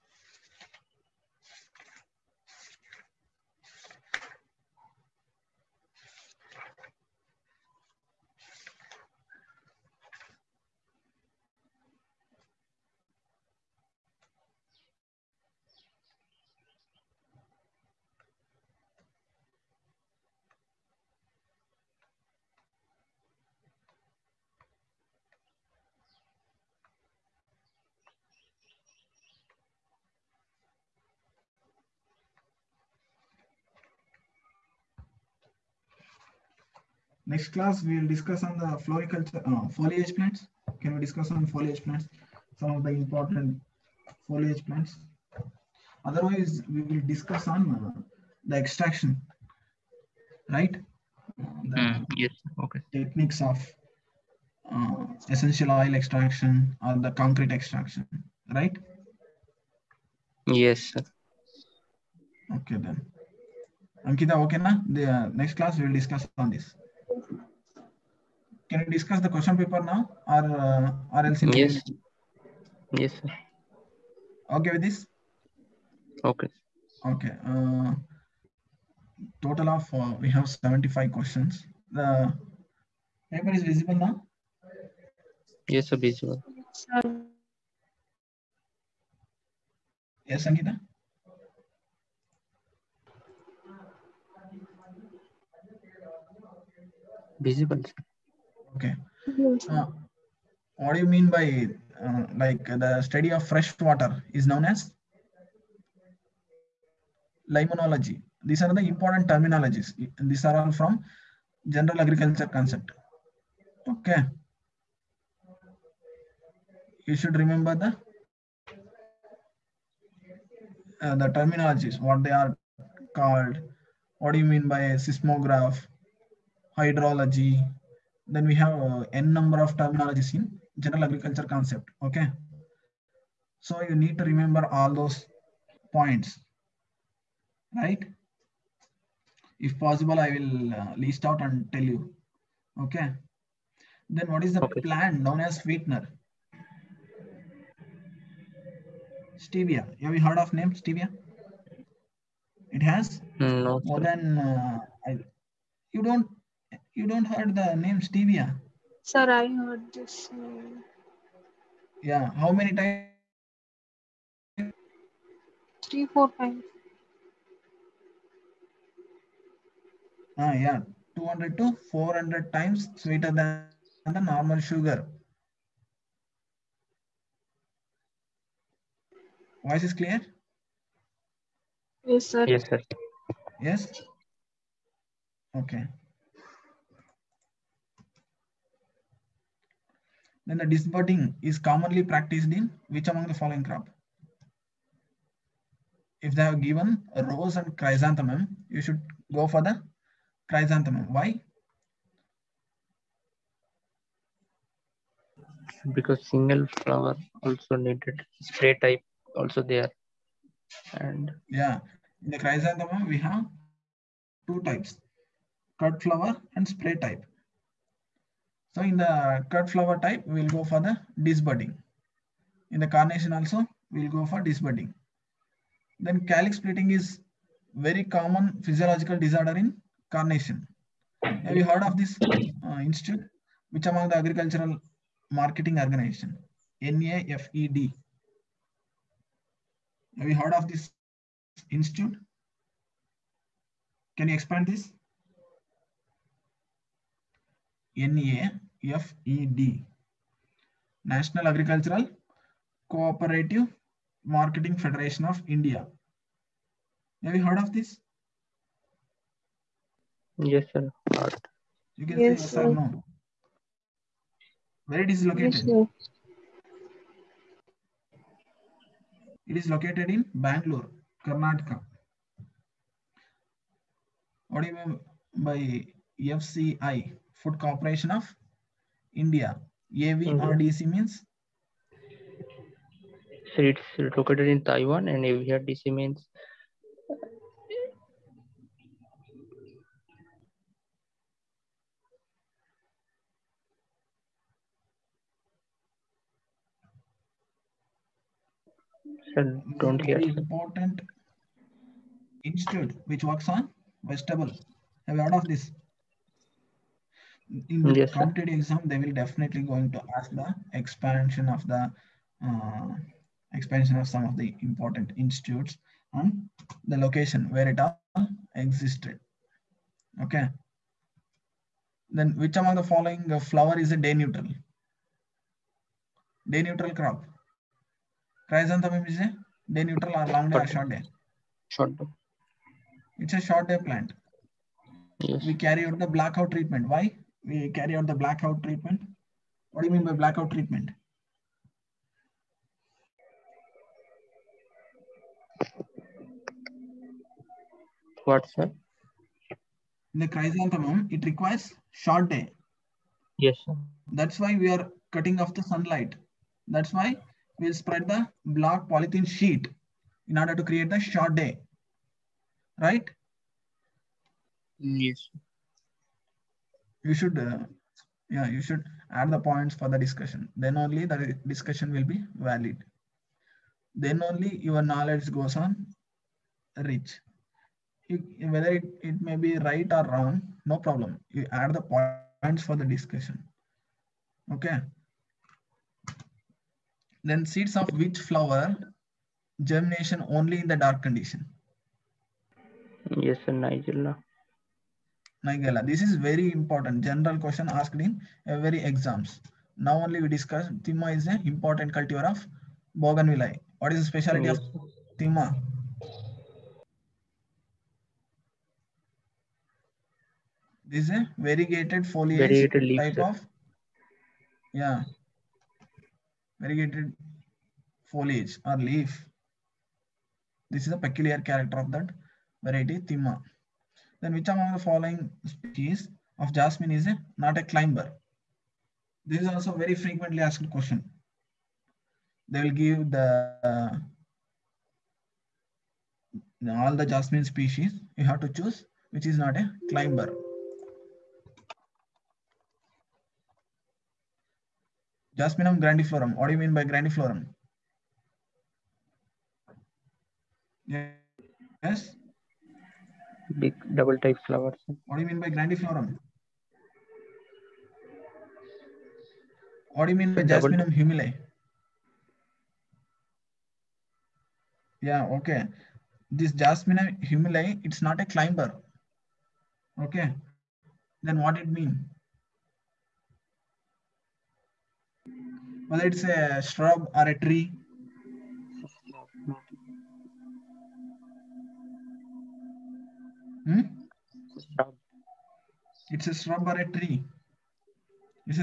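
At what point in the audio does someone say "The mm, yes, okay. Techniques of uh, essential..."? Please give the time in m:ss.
0:51.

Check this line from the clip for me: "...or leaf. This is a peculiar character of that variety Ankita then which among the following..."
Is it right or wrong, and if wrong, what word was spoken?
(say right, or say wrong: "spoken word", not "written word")
wrong: "Thimma", not "Ankita".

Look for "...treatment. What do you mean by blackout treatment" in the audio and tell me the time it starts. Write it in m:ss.
5:38.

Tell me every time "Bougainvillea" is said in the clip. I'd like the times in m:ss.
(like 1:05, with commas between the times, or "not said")
6:42.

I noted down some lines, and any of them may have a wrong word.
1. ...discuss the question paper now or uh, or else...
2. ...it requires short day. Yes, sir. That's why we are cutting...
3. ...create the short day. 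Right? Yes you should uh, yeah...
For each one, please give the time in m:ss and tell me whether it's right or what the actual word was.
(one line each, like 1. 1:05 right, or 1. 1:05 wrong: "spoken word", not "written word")
1. 1:08 right
2. 5:51 right
3. 6:00 right.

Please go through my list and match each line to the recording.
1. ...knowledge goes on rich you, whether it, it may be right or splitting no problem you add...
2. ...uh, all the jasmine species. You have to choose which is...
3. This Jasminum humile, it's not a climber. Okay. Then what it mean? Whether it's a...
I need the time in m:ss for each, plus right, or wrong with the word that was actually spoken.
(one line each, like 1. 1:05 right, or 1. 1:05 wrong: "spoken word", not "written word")
1. 6:14 wrong: "wrong", not "splitting"
2. 7:13 right
3. 7:46 right.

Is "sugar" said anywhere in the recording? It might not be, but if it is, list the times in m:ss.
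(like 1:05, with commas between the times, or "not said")
2:54.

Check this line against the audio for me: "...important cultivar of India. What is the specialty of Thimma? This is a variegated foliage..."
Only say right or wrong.
wrong.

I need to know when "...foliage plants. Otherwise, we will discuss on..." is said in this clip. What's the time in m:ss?
0:44.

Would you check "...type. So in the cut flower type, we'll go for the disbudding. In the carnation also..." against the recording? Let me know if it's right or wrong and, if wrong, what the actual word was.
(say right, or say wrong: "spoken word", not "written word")
right.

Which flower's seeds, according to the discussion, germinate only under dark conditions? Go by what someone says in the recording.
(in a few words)
Nigella.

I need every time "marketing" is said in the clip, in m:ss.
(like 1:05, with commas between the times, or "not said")
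3:55, 4:14.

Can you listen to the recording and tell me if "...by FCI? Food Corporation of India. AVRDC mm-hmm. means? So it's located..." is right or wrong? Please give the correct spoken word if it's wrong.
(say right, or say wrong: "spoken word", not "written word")
right.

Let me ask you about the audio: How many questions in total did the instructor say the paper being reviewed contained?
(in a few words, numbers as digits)
75.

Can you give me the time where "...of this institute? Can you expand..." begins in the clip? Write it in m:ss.
4:00.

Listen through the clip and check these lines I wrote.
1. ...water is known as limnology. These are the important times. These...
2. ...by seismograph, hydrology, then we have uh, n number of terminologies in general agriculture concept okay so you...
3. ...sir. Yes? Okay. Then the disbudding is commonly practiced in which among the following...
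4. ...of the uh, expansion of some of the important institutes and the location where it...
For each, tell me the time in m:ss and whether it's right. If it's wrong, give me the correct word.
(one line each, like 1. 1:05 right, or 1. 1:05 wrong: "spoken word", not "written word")
1. 1:43 wrong: "terminologies", not "times"
2. 2:04 right
3. 3:02 right
4. 5:11 right.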